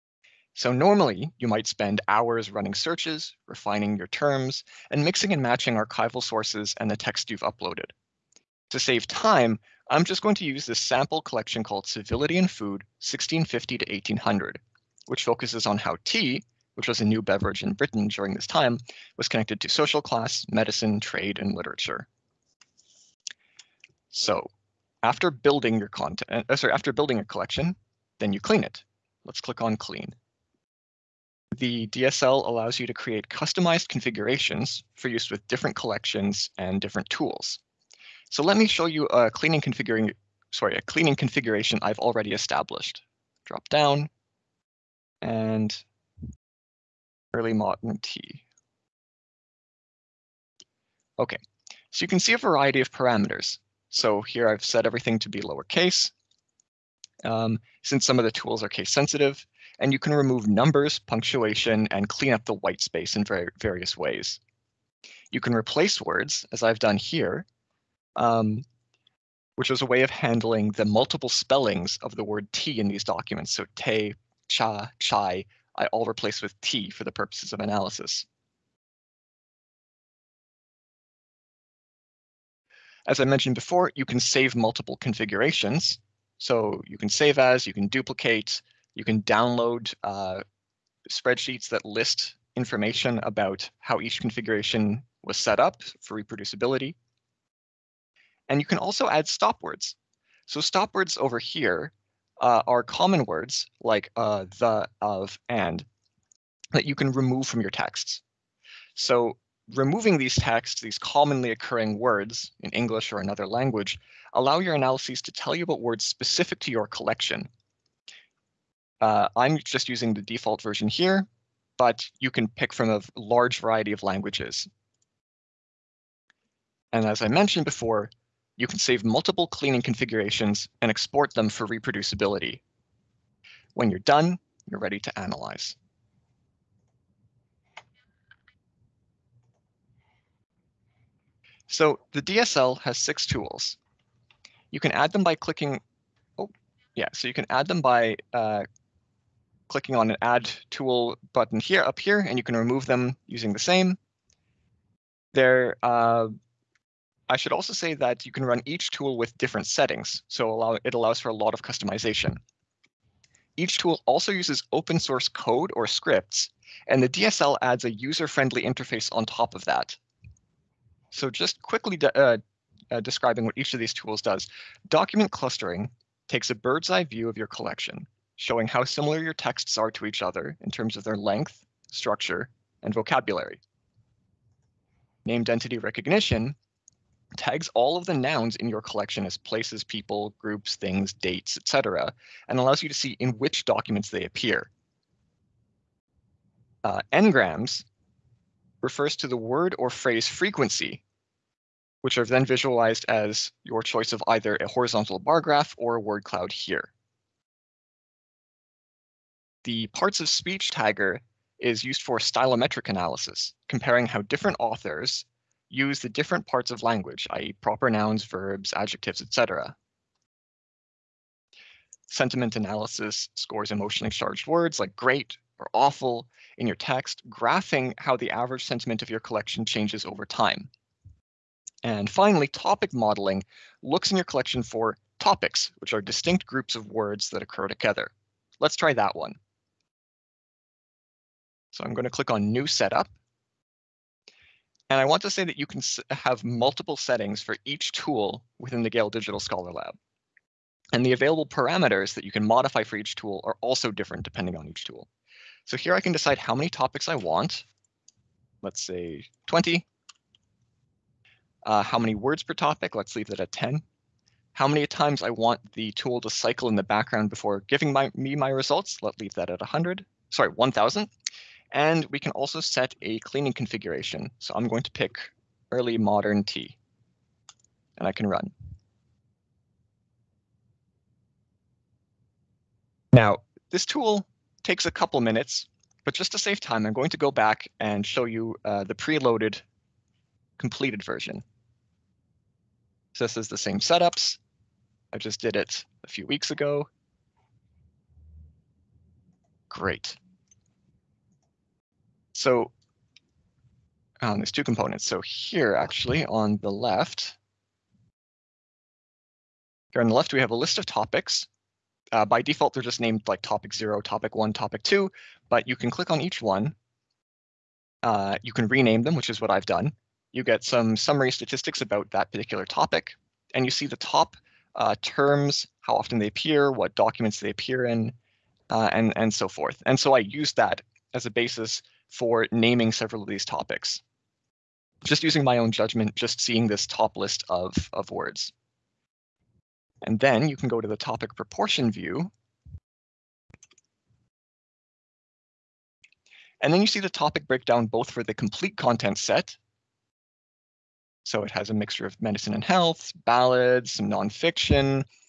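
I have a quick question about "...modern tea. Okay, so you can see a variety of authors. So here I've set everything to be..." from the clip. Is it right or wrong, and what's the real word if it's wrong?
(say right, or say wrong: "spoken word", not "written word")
wrong: "parameters", not "authors".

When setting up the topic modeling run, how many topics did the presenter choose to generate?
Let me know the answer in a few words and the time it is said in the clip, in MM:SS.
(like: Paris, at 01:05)
20, at 04:19.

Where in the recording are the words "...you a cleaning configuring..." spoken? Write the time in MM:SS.
00:38.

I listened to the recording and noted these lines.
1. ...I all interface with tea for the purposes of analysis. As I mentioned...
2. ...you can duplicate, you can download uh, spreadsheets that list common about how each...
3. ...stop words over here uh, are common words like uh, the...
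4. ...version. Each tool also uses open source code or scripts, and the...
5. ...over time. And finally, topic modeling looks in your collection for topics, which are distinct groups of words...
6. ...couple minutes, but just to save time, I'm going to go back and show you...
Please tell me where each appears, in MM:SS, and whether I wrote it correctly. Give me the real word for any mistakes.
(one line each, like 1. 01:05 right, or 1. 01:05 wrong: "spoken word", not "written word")
1. 01:15 wrong: "replace", not "interface"
2. 01:27 wrong: "information", not "common"
3. 01:40 right
4. 02:41 wrong: "customization", not "version"
5. 03:50 right
6. 04:44 right.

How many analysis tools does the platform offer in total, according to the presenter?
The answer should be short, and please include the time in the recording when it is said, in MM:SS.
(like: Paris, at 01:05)
6, at 02:22.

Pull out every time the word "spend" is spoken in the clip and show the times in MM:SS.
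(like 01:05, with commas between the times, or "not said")
00:01.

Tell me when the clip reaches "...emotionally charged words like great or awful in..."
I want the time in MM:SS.
03:43.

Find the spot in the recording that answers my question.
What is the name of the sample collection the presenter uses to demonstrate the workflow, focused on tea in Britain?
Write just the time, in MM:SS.
00:11.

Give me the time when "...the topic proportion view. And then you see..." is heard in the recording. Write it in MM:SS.
05:40.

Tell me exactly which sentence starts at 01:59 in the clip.
Uh, I'm just using the default version here, but you can pick from a large variety of languages.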